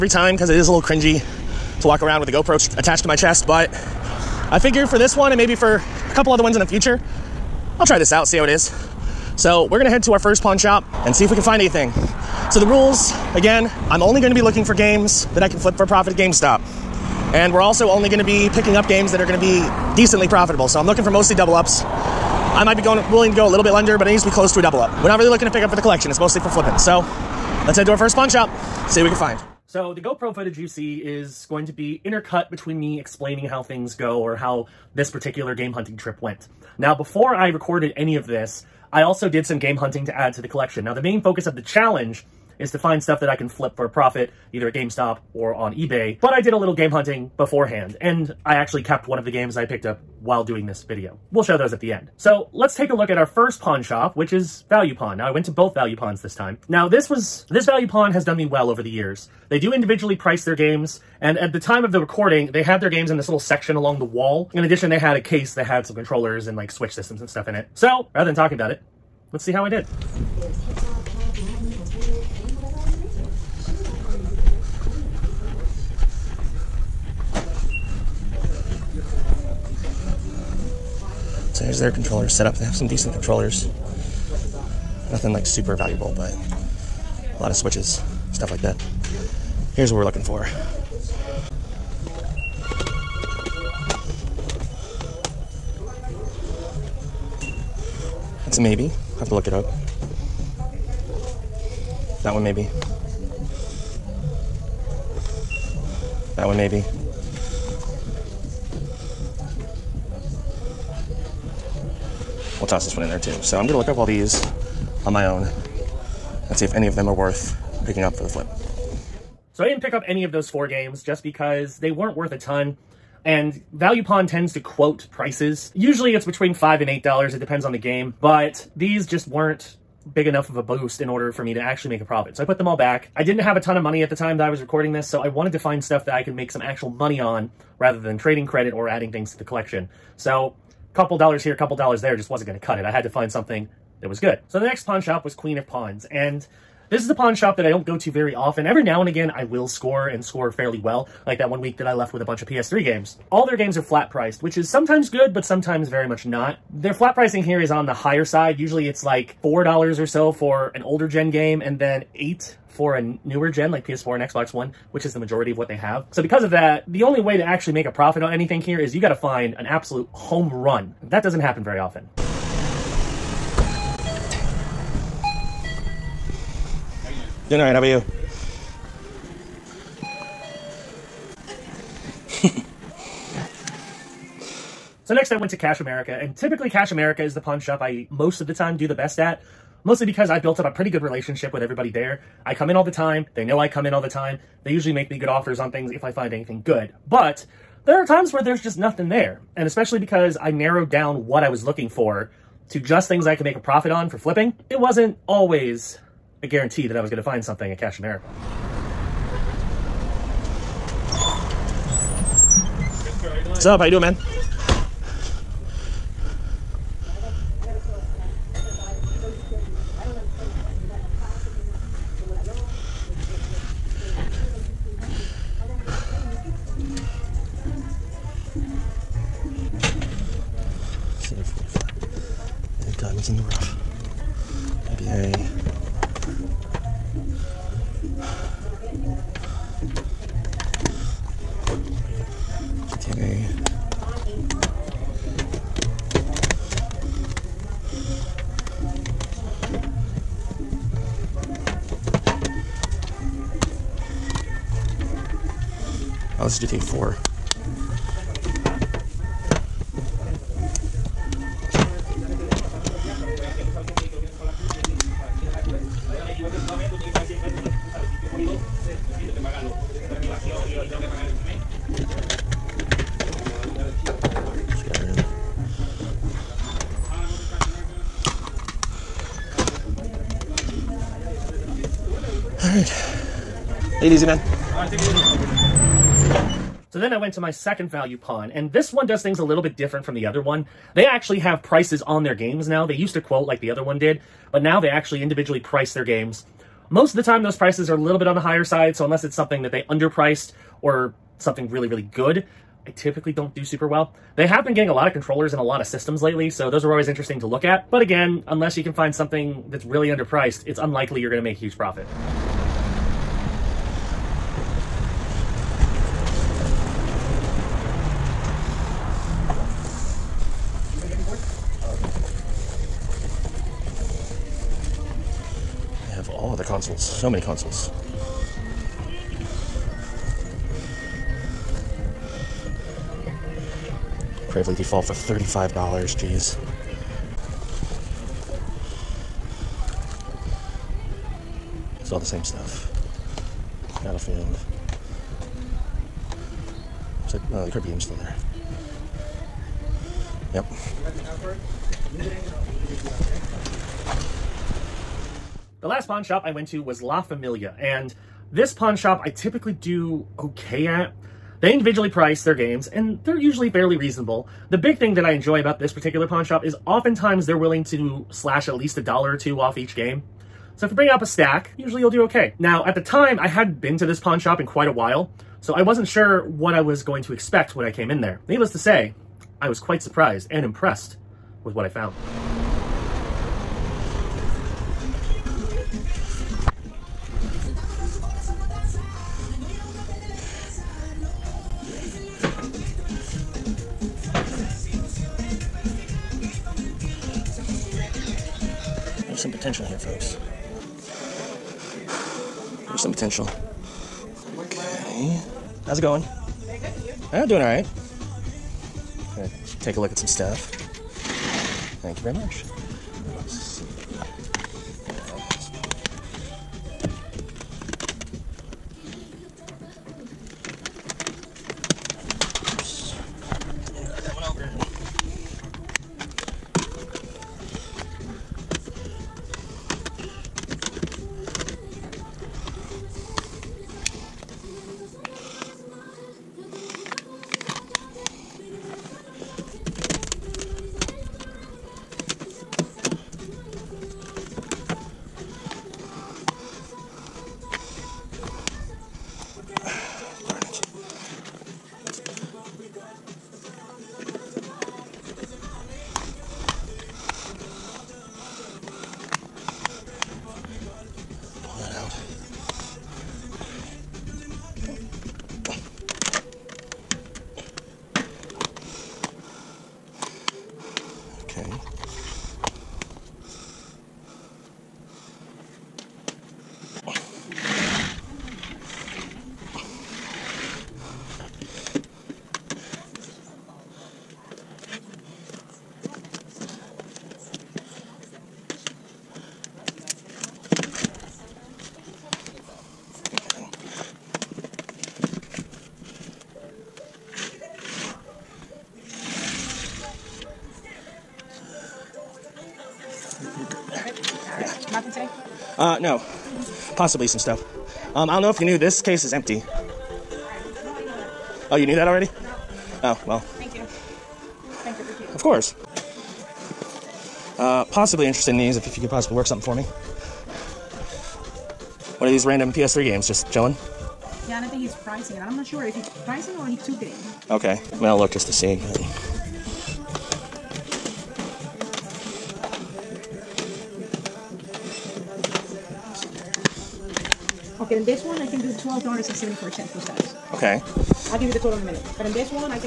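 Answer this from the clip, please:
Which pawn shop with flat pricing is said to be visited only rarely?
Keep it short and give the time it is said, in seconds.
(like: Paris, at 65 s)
Queen of Pawns, at 145 s.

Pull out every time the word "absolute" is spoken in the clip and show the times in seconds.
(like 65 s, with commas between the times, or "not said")
169 s.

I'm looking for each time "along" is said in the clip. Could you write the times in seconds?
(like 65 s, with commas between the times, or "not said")
63 s.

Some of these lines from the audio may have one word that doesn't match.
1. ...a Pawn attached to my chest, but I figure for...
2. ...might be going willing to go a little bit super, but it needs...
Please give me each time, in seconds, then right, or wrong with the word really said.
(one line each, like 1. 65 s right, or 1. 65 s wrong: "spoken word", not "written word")
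1. 2 s wrong: "GoPro", not "Pawn"
2. 22 s wrong: "under", not "super".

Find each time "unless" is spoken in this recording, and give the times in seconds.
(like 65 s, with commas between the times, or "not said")
299 s, 308 s.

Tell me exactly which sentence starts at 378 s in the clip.
Needless to say, I was quite surprised and impressed with what I found.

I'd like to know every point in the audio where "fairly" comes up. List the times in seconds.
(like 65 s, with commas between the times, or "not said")
150 s, 363 s.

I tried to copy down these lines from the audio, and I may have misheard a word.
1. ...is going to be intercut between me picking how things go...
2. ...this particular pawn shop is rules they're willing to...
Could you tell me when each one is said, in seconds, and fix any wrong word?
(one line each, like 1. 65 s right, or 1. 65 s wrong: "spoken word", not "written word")
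1. 30 s wrong: "explaining", not "picking"
2. 365 s wrong: "oftentimes", not "rules".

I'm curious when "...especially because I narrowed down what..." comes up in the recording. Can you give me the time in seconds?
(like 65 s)
199 s.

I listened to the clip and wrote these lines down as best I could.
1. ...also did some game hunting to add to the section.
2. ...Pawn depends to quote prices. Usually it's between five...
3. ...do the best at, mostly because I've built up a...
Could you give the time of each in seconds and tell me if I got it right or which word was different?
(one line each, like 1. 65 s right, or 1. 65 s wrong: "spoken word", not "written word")
1. 39 s wrong: "collection", not "section"
2. 124 s wrong: "tends", not "depends"
3. 188 s right.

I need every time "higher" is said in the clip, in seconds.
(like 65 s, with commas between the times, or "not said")
157 s, 298 s.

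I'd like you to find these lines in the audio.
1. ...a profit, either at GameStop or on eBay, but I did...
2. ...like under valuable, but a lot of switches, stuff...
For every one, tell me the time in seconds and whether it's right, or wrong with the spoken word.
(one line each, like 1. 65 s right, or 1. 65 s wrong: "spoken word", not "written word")
1. 43 s right
2. 85 s wrong: "super", not "under".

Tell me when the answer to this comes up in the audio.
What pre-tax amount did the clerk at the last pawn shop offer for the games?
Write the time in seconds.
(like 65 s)
538 s.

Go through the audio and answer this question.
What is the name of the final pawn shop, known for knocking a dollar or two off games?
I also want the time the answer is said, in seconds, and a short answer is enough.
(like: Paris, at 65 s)
La Familia, at 357 s.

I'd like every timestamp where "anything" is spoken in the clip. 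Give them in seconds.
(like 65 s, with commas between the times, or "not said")
11 s, 168 s, 196 s.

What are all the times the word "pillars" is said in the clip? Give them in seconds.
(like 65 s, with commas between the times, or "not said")
not said.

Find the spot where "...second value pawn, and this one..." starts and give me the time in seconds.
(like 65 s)
287 s.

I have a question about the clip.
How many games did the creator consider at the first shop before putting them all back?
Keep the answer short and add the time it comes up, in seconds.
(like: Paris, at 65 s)
4, at 120 s.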